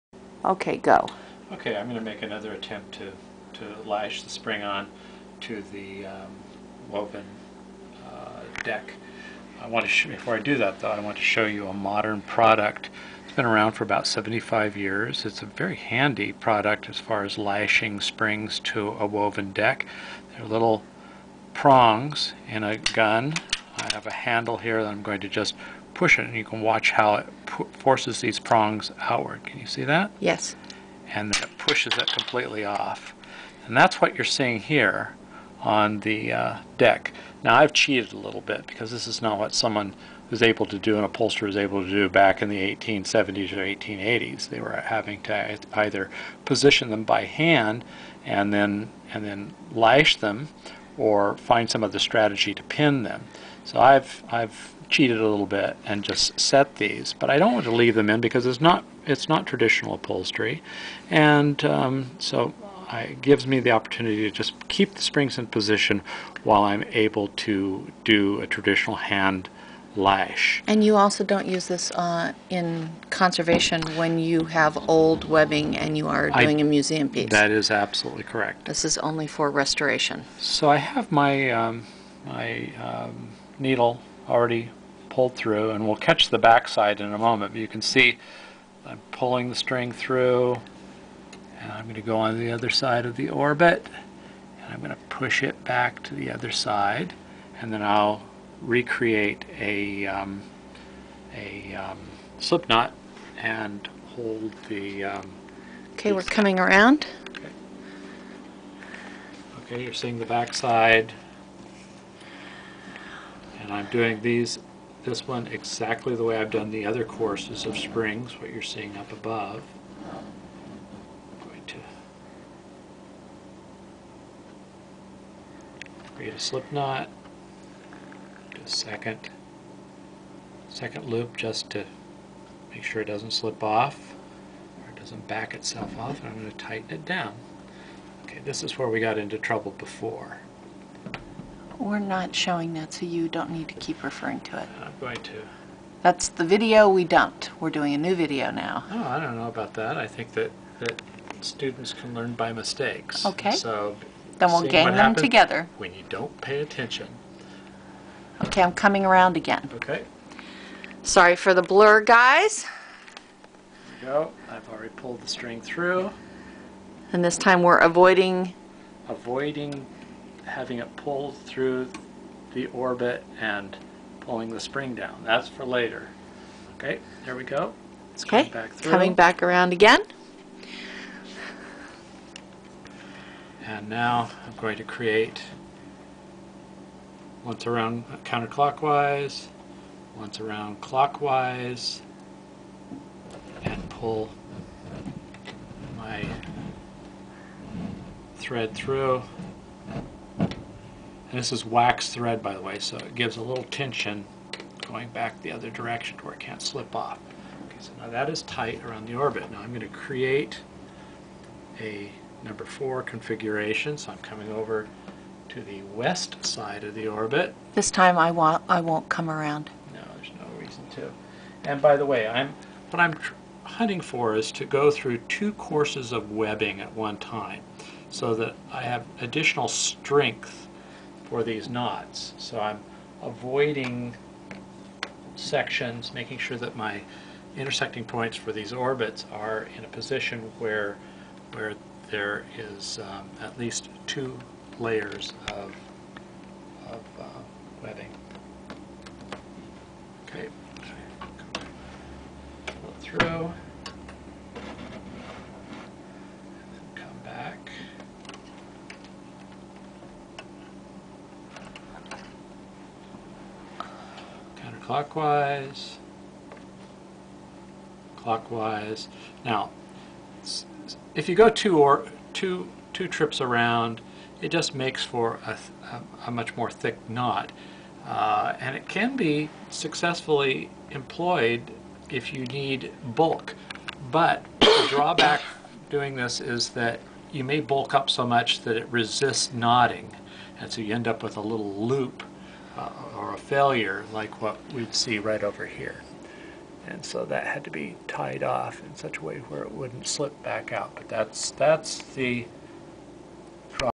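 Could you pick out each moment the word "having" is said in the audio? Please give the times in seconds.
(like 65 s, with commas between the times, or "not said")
44 s, 170 s.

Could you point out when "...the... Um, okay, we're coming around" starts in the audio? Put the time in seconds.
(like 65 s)
104 s.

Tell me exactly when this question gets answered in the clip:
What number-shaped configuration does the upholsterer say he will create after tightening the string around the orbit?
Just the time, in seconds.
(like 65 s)
212 s.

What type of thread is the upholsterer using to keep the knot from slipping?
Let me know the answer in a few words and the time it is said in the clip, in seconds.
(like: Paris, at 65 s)
wax thread, at 201 s.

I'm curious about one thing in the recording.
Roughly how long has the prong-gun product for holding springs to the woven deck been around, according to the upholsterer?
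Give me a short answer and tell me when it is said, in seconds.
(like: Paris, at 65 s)
75 years, at 13 s.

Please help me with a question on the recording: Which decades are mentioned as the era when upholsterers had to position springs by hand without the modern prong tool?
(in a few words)
1870s or 1880s.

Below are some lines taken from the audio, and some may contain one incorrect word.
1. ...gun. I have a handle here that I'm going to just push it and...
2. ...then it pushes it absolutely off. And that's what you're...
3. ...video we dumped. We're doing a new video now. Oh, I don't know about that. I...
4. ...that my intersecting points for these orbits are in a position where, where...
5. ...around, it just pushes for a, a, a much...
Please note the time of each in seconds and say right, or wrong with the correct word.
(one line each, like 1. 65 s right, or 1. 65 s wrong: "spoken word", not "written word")
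1. 22 s right
2. 31 s wrong: "completely", not "absolutely"
3. 146 s right
4. 236 s right
5. 273 s wrong: "makes", not "pushes".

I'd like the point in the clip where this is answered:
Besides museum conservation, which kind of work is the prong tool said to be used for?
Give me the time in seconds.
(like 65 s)
79 s.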